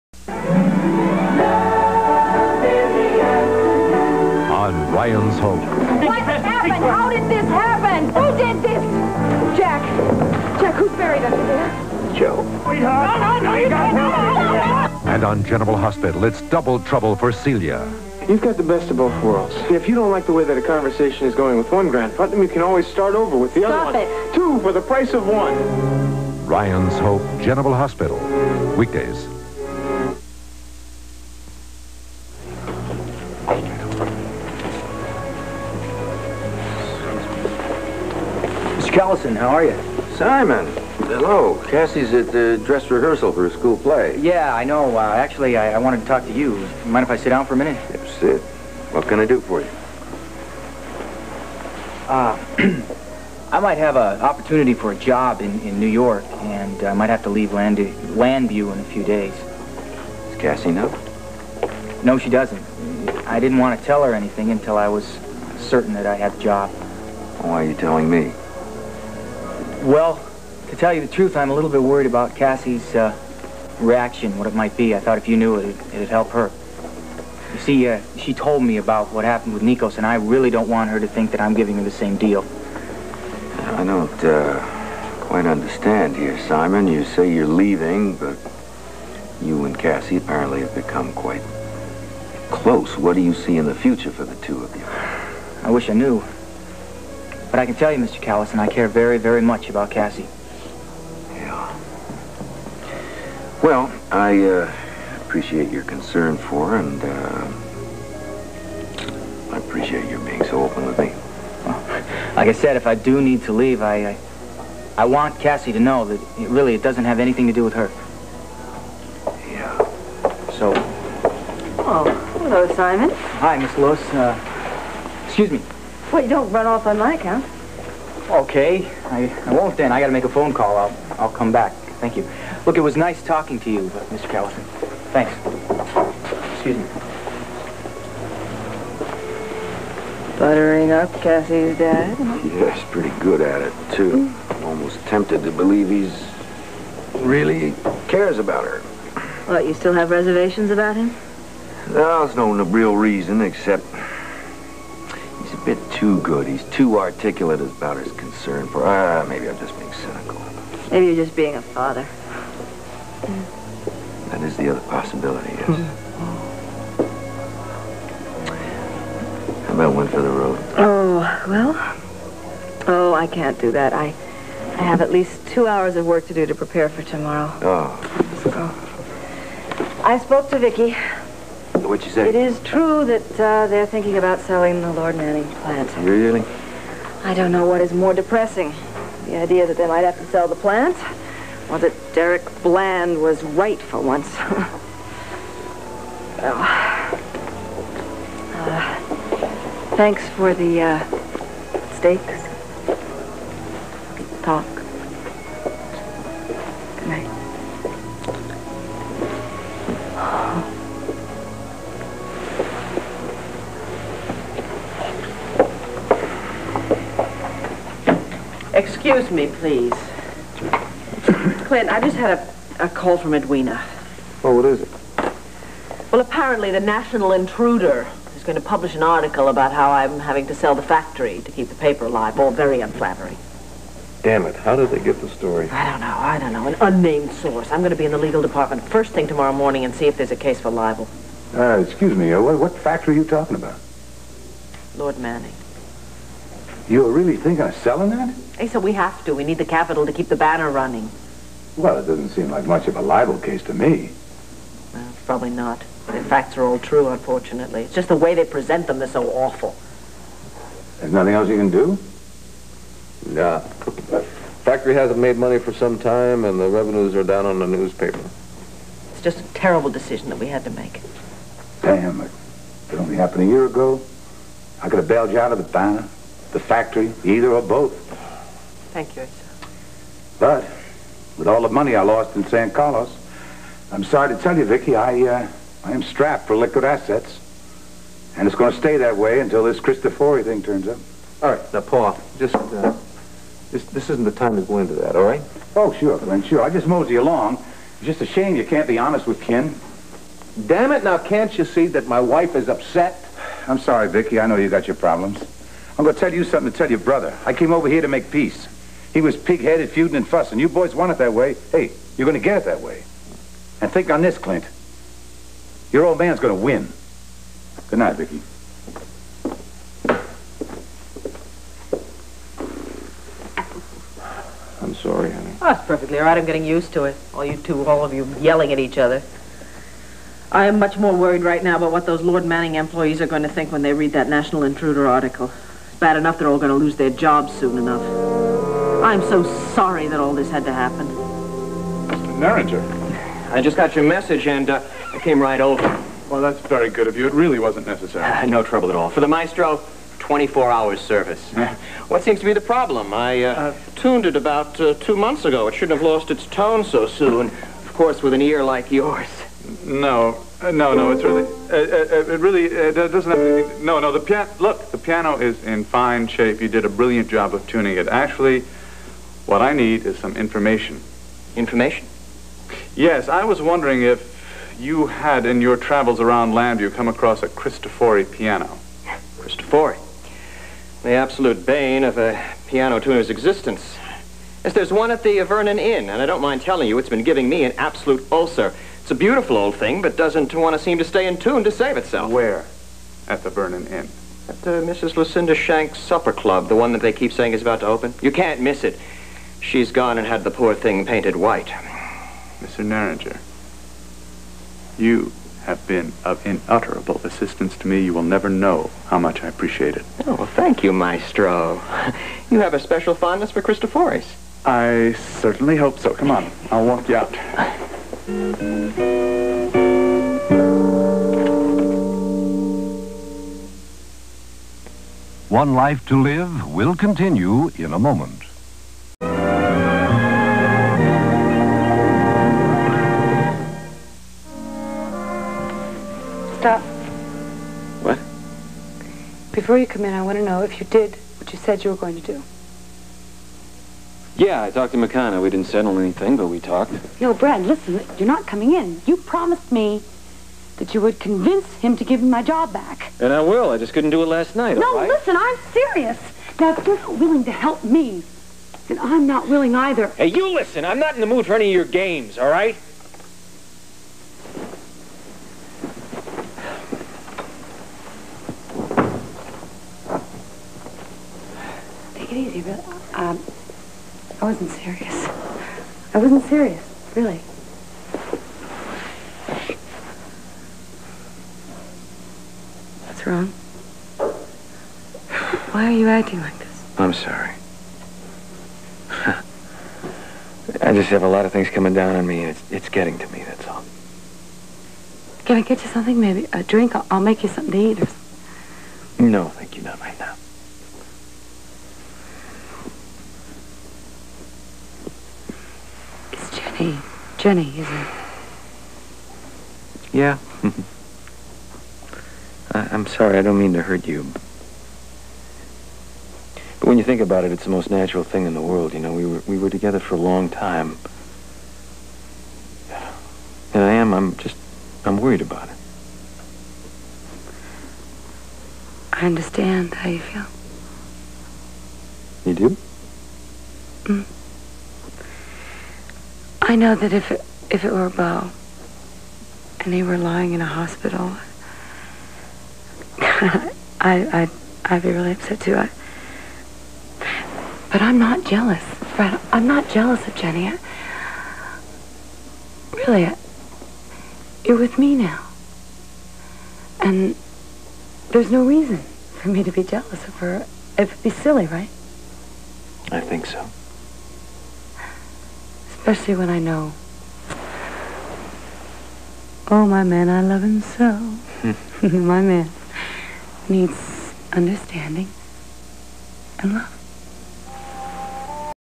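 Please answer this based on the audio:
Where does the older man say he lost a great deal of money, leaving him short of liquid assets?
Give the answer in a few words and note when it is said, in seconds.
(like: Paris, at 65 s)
San Carlos, at 282 s.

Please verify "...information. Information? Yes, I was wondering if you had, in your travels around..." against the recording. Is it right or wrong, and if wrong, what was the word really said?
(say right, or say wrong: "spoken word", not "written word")
right.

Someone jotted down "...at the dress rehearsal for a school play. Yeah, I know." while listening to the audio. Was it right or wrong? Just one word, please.
right.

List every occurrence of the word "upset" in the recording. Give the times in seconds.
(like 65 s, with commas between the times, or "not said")
302 s, 545 s.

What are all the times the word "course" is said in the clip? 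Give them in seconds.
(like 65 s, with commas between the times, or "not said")
357 s.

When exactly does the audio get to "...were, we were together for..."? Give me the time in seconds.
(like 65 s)
519 s.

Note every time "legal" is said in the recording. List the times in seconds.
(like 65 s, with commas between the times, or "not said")
238 s.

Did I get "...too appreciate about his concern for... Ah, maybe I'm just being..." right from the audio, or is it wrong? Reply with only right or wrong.
wrong.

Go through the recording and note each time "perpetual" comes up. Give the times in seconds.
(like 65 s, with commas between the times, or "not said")
not said.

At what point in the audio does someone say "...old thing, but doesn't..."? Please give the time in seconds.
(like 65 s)
389 s.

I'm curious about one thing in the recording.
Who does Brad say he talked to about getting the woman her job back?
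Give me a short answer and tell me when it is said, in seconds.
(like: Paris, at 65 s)
McKenna, at 444 s.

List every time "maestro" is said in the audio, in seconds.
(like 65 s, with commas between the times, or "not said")
349 s, 410 s.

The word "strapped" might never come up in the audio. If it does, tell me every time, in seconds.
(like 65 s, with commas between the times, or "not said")
286 s.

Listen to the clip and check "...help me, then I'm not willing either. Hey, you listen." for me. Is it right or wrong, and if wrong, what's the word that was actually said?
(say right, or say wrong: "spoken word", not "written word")
right.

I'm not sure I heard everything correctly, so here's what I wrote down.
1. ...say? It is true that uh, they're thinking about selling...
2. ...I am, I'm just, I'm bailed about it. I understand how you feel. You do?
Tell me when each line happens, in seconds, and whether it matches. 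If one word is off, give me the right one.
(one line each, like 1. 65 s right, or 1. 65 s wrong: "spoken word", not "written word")
1. 182 s right
2. 523 s wrong: "worried", not "bailed".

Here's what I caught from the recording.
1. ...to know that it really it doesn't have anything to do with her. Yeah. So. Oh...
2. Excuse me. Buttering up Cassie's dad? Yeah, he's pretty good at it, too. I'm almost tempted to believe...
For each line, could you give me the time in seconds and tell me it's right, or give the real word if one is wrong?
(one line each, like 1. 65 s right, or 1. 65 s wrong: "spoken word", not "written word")
1. 115 s right
2. 136 s right.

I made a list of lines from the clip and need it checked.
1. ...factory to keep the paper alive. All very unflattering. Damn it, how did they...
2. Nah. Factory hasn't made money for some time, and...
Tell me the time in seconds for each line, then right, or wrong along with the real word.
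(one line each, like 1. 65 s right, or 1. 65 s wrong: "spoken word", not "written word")
1. 230 s right
2. 263 s right.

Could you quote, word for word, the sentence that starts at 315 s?
Your old man's going to win.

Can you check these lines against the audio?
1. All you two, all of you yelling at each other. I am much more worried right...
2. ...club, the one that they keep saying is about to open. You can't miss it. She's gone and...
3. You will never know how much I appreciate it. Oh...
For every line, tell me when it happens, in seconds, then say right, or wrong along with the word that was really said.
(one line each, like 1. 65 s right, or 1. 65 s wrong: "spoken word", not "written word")
1. 327 s right
2. 396 s right
3. 408 s right.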